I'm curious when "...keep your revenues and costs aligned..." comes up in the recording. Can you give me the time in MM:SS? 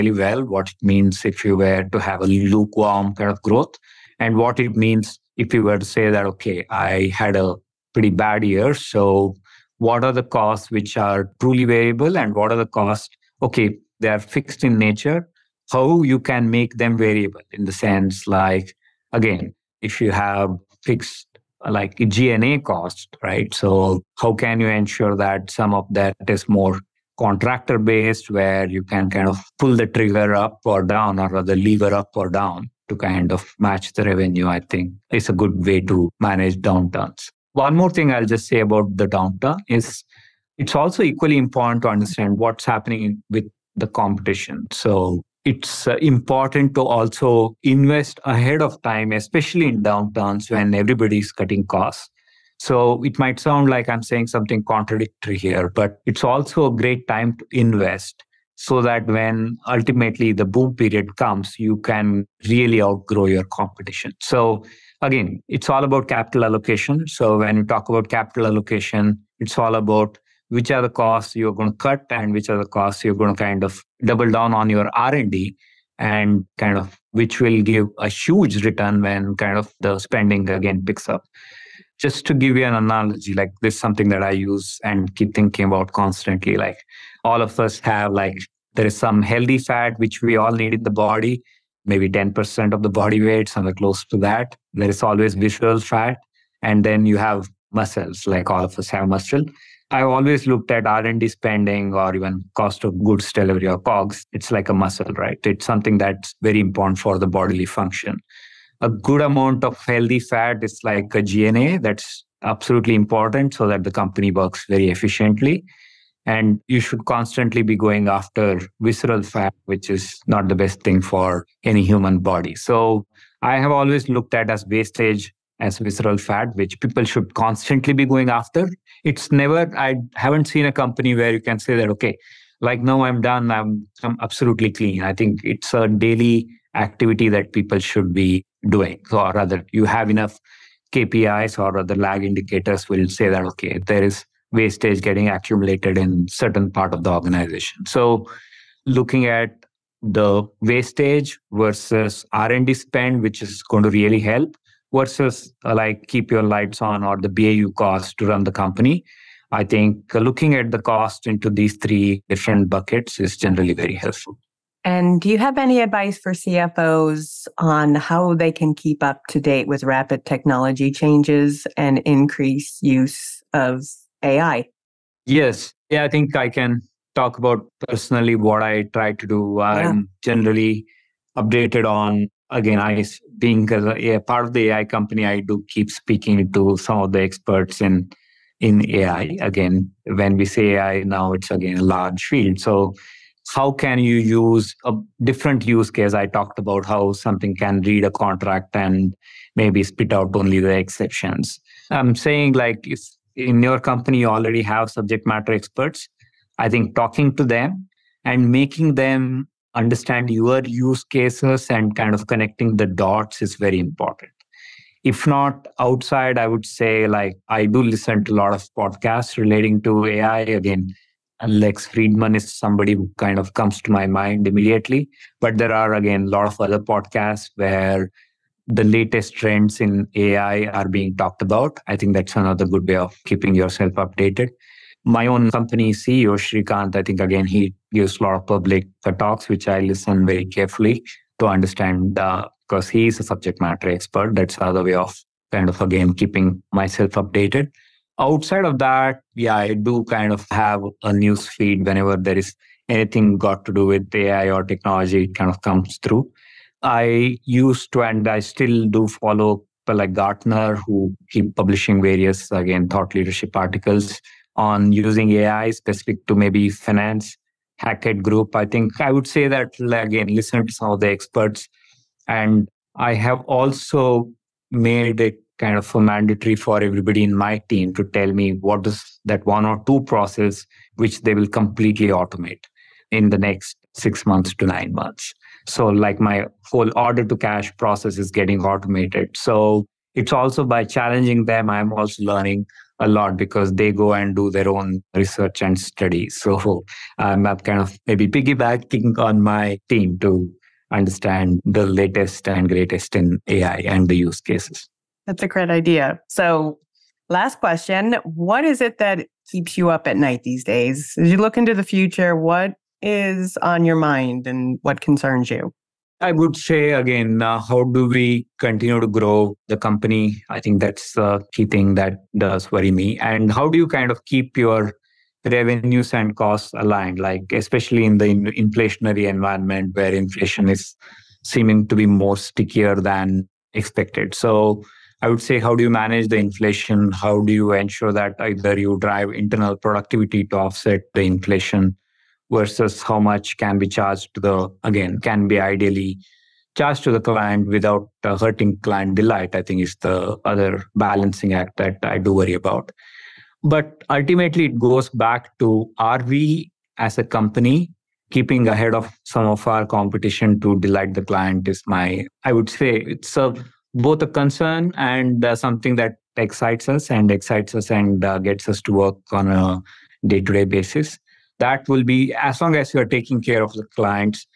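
05:24.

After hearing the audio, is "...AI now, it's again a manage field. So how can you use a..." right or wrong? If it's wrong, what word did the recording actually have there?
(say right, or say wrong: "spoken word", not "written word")
wrong: "large", not "manage".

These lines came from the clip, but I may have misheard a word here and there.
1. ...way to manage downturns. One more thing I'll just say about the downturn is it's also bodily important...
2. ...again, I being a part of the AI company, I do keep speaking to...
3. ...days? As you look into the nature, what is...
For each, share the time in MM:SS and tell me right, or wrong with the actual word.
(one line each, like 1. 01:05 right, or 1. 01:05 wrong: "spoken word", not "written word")
1. 00:35 wrong: "equally", not "bodily"
2. 03:02 right
3. 05:10 wrong: "future", not "nature".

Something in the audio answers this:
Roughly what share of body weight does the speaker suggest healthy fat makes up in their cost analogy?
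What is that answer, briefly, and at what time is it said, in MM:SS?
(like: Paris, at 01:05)
10%, at 01:32.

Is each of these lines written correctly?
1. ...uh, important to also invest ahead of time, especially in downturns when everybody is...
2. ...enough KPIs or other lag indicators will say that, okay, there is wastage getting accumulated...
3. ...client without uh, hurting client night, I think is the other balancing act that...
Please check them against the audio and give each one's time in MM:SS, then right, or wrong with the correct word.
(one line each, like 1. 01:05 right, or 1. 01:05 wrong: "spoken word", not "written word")
1. 00:45 right
2. 02:20 right
3. 05:47 wrong: "delight", not "night".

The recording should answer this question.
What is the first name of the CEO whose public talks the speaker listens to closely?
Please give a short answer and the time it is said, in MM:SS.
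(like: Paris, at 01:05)
Srikanth, at 03:56.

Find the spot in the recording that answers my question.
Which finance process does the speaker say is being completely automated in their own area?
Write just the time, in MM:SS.
04:46.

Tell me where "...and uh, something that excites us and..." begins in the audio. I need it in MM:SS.
06:04.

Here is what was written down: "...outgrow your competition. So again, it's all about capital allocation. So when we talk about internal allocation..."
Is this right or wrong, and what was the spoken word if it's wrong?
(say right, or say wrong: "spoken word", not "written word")
wrong: "capital", not "internal".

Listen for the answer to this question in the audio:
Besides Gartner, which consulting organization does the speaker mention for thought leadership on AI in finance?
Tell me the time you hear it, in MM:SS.
04:27.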